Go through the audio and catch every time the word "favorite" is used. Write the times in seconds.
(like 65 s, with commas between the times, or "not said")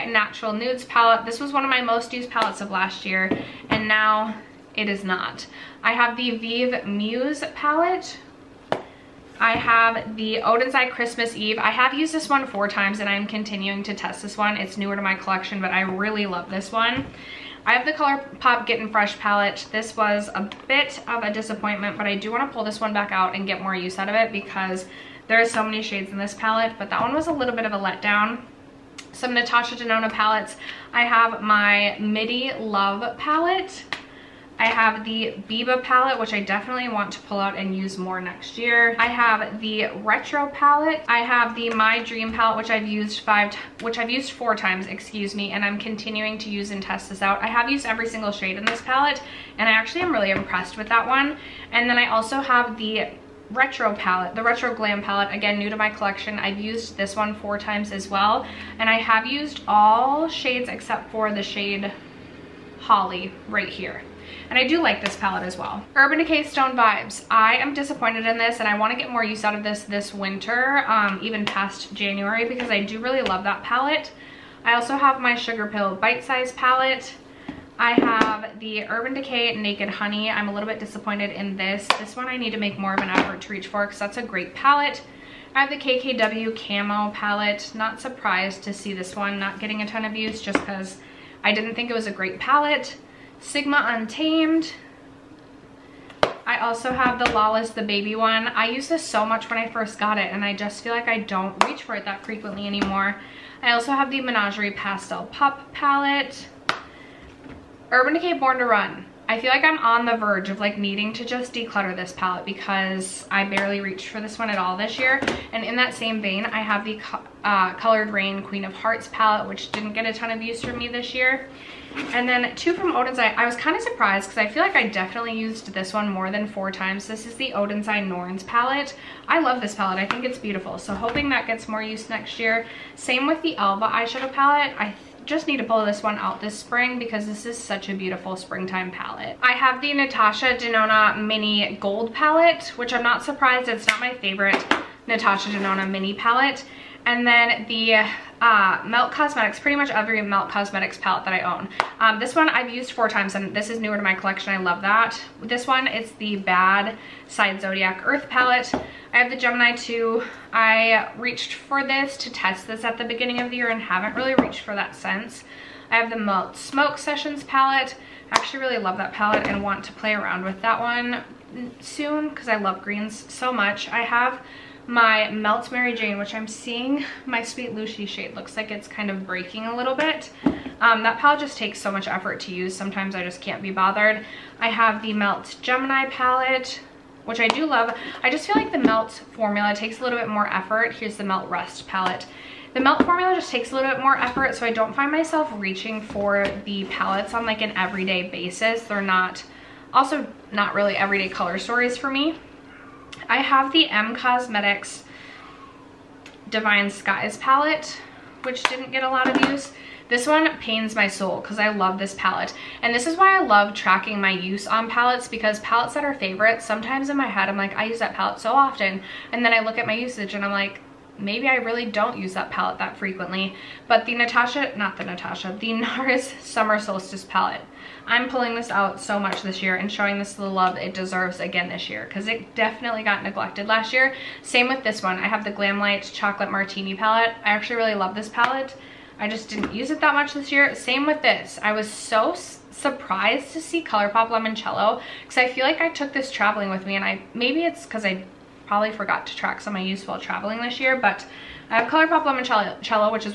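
144 s, 216 s.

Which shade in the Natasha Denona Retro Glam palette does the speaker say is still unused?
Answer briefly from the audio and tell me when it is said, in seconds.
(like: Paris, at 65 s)
Holly, at 62 s.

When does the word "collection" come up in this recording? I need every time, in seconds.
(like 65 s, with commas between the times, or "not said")
15 s, 55 s, 154 s.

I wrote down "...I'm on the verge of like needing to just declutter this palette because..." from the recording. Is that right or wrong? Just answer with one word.
right.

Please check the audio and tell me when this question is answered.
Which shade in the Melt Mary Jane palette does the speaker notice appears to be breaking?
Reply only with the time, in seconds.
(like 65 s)
177 s.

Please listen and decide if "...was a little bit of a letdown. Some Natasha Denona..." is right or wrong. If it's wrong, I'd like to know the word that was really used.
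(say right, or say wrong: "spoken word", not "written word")
right.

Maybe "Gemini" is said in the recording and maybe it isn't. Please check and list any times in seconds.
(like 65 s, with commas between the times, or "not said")
159 s, 185 s.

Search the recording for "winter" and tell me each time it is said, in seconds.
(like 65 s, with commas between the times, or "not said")
70 s.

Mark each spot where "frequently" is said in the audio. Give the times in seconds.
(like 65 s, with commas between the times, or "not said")
102 s, 222 s.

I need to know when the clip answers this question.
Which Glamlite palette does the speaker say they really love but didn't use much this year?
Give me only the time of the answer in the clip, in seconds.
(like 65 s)
236 s.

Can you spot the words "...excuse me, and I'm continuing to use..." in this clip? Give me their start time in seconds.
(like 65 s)
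44 s.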